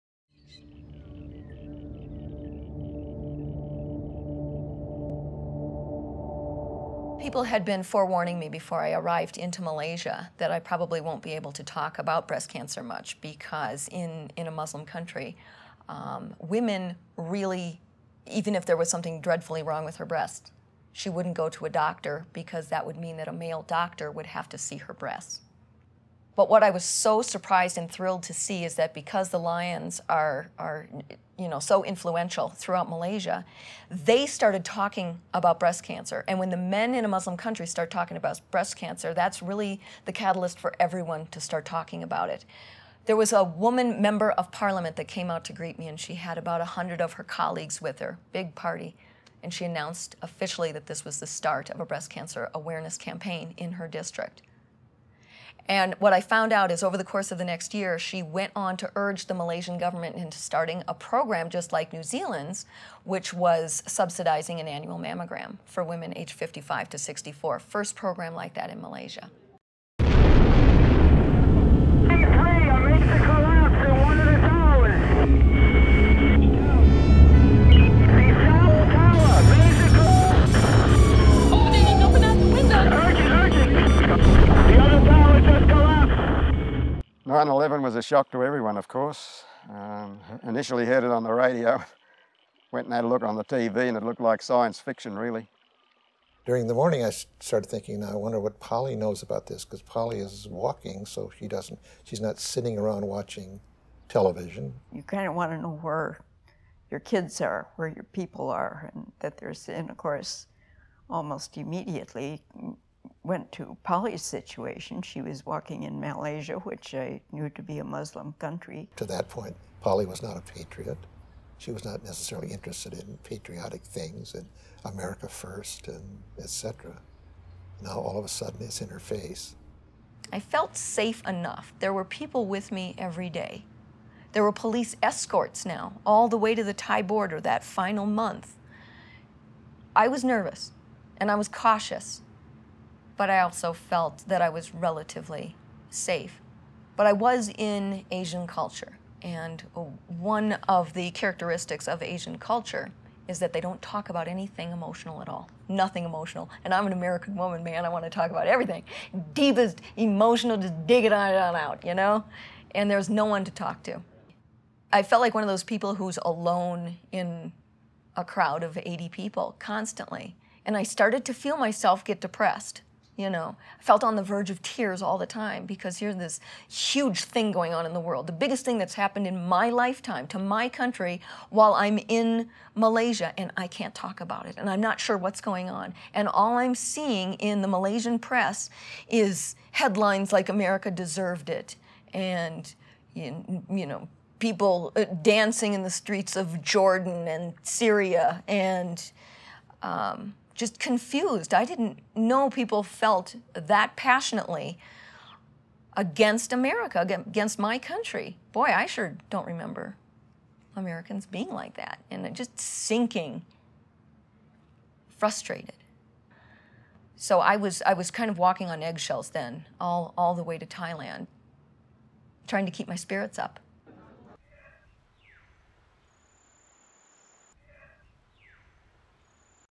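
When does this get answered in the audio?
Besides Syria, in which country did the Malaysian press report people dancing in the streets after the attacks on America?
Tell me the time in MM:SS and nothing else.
03:16.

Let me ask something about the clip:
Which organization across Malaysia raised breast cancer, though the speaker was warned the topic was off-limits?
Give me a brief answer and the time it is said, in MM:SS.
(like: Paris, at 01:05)
The Lions, at 00:29.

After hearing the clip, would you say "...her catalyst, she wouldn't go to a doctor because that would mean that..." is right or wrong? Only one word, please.
wrong.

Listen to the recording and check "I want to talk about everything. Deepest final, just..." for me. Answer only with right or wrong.
wrong.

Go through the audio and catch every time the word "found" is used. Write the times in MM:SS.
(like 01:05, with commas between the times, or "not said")
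00:56.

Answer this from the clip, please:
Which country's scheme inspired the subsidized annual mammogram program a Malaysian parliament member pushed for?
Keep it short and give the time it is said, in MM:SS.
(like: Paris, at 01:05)
New Zealand, at 01:01.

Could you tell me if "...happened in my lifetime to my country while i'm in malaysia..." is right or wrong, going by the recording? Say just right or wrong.
right.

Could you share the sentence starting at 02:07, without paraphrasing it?
Now all of a sudden it's in her face.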